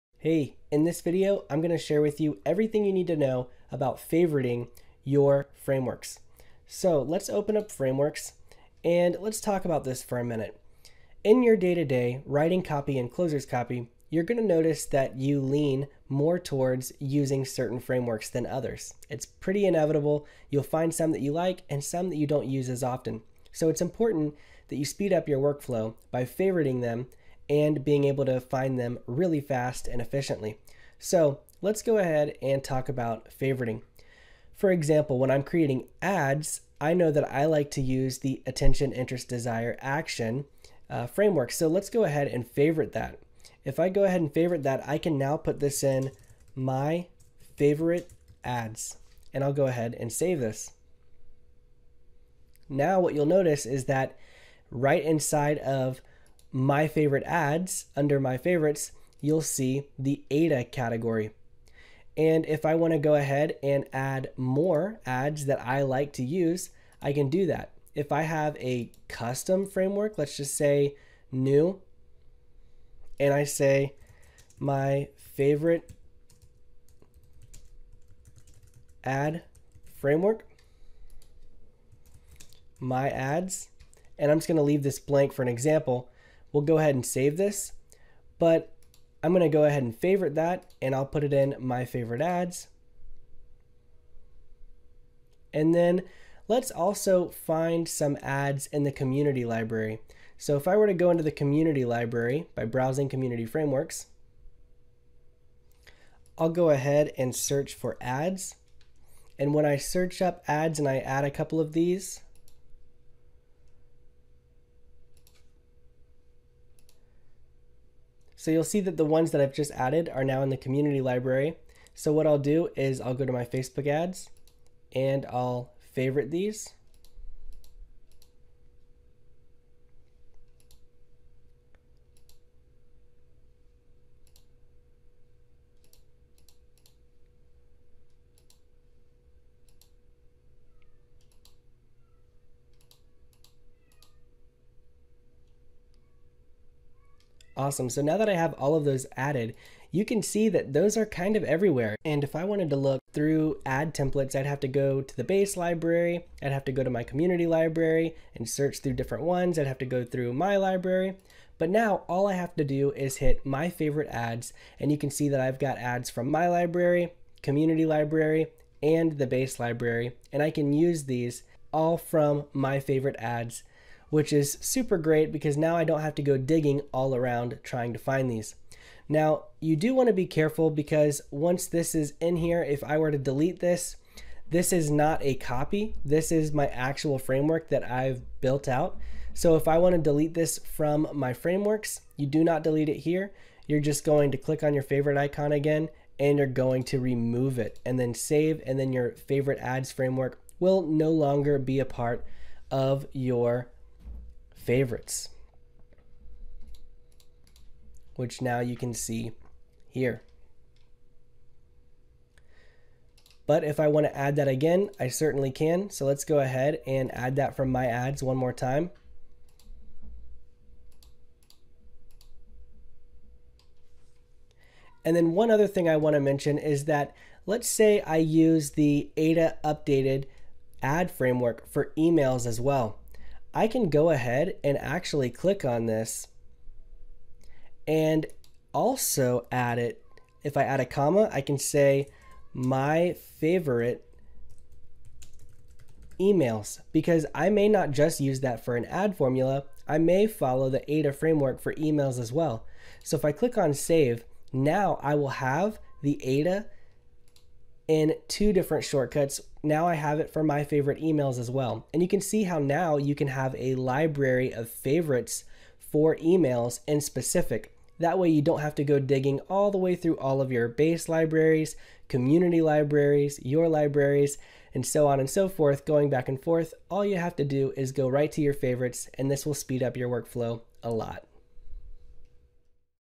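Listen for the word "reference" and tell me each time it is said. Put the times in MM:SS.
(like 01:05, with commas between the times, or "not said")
not said.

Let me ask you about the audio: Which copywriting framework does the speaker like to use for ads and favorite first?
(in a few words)
Attention, interest, desire, action.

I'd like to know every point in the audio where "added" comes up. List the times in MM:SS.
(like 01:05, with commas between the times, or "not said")
01:59, 02:29.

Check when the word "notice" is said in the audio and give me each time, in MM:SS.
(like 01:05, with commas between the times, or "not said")
00:14, 00:53.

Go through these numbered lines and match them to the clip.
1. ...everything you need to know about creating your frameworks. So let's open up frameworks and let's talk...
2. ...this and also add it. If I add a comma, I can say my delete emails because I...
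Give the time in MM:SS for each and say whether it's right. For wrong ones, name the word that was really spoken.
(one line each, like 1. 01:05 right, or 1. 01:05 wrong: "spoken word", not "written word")
1. 00:02 wrong: "favoriting", not "creating"
2. 03:55 wrong: "favorite", not "delete".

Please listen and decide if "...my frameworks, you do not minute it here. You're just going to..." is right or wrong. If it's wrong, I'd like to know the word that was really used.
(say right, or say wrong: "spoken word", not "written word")
wrong: "delete", not "minute".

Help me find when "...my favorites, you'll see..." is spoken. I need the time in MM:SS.
00:58.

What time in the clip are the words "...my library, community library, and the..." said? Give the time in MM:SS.
02:46.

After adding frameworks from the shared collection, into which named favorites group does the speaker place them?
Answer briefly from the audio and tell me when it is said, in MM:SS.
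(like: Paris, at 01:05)
Facebook ads, at 02:03.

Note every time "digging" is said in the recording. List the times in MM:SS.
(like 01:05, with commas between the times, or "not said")
02:56, 04:28.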